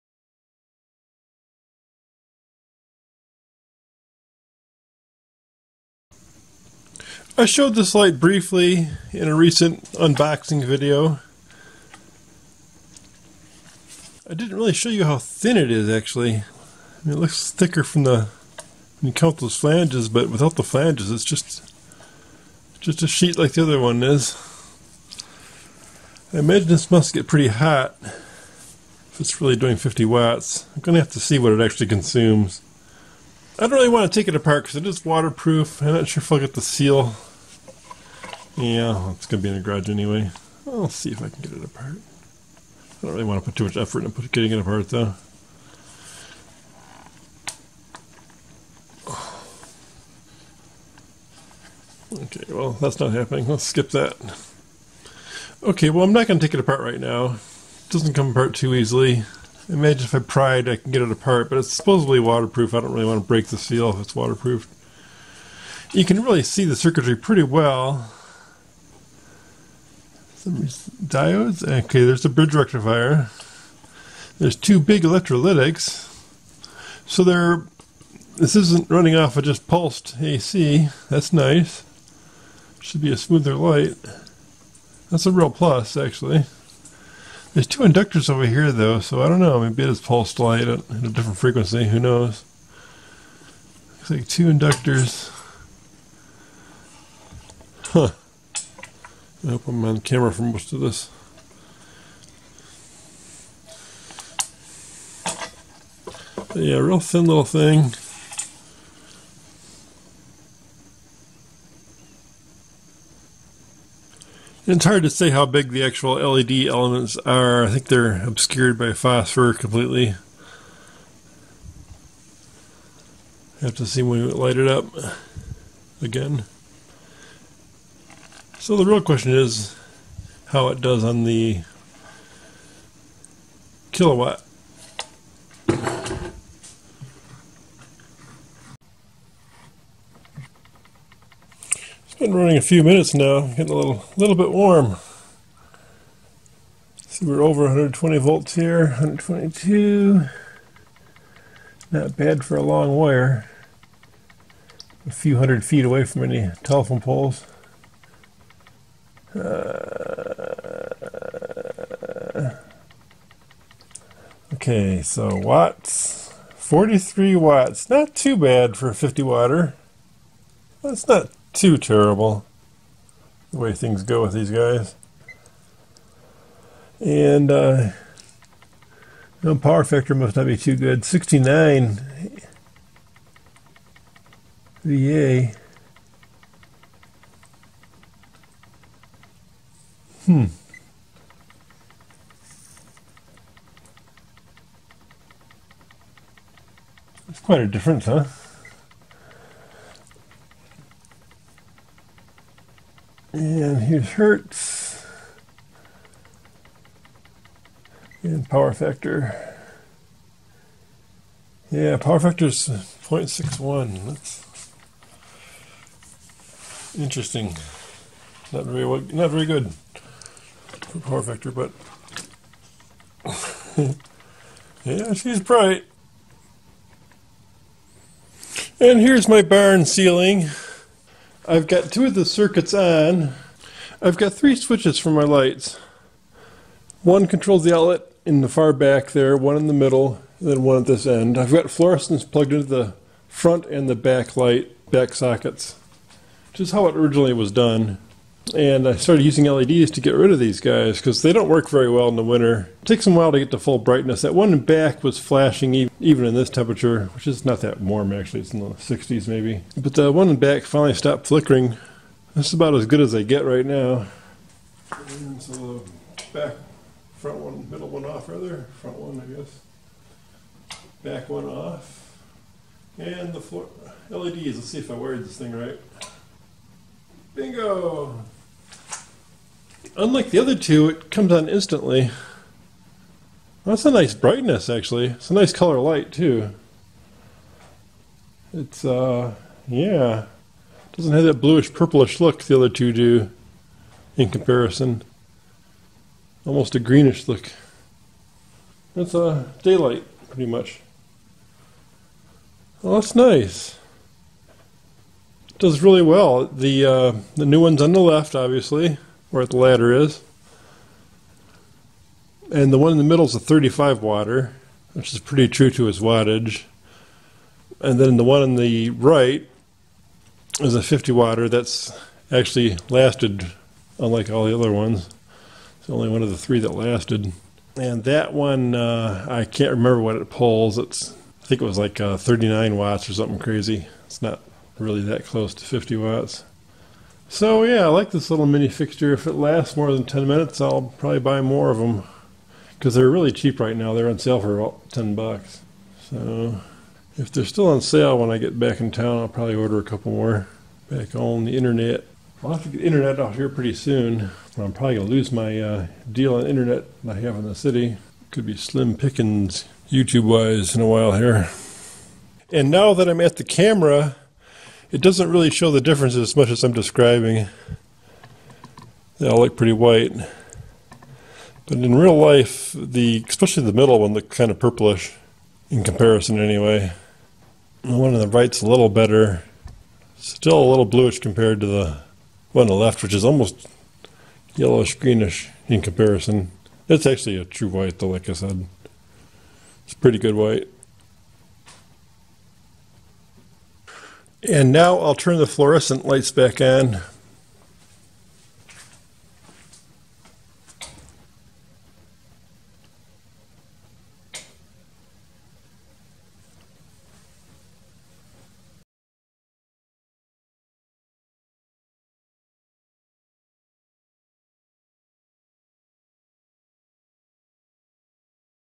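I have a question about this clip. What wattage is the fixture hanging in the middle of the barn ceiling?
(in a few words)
35.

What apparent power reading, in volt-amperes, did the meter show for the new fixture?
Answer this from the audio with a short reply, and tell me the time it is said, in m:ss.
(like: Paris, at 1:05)
69 VA, at 3:01.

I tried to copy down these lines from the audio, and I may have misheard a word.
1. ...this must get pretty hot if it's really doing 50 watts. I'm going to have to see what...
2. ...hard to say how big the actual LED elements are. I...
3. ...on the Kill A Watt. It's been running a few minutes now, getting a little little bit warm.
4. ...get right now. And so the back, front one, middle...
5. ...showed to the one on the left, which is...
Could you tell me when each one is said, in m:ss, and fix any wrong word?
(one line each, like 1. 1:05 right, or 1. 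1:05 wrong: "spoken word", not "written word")
1. 0:26 right
2. 1:54 right
3. 2:11 right
4. 4:23 right
5. 6:21 wrong: "compared", not "showed".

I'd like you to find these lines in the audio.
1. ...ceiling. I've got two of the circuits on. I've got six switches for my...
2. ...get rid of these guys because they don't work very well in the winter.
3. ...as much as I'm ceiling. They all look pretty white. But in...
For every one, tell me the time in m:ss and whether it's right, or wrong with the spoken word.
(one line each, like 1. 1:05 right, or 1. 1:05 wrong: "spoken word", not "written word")
1. 3:49 wrong: "three", not "six"
2. 4:10 right
3. 6:06 wrong: "describing", not "ceiling".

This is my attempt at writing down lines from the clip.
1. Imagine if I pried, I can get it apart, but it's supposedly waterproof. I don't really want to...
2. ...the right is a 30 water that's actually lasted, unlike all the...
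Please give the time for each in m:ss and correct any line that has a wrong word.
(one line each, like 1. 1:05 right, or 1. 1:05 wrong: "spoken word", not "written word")
1. 0:59 right
2. 5:18 wrong: "50", not "30".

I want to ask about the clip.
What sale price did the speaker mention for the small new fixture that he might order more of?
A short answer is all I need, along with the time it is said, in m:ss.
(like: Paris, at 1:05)
about $10, at 5:44.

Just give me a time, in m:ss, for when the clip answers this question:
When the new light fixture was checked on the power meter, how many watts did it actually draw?
2:46.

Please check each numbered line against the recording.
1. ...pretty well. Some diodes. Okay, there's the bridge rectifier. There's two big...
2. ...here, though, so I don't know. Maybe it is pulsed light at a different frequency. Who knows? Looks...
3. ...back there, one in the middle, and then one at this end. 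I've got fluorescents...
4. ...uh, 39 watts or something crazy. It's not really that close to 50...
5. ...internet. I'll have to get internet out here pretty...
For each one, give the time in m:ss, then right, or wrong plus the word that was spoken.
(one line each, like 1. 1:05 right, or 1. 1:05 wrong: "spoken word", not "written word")
1. 1:07 right
2. 1:28 right
3. 3:58 right
4. 5:31 right
5. 5:51 right.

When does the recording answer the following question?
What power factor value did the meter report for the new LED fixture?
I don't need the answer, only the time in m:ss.
3:32.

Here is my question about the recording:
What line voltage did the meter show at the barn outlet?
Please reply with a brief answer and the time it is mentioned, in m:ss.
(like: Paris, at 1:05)
122, at 2:28.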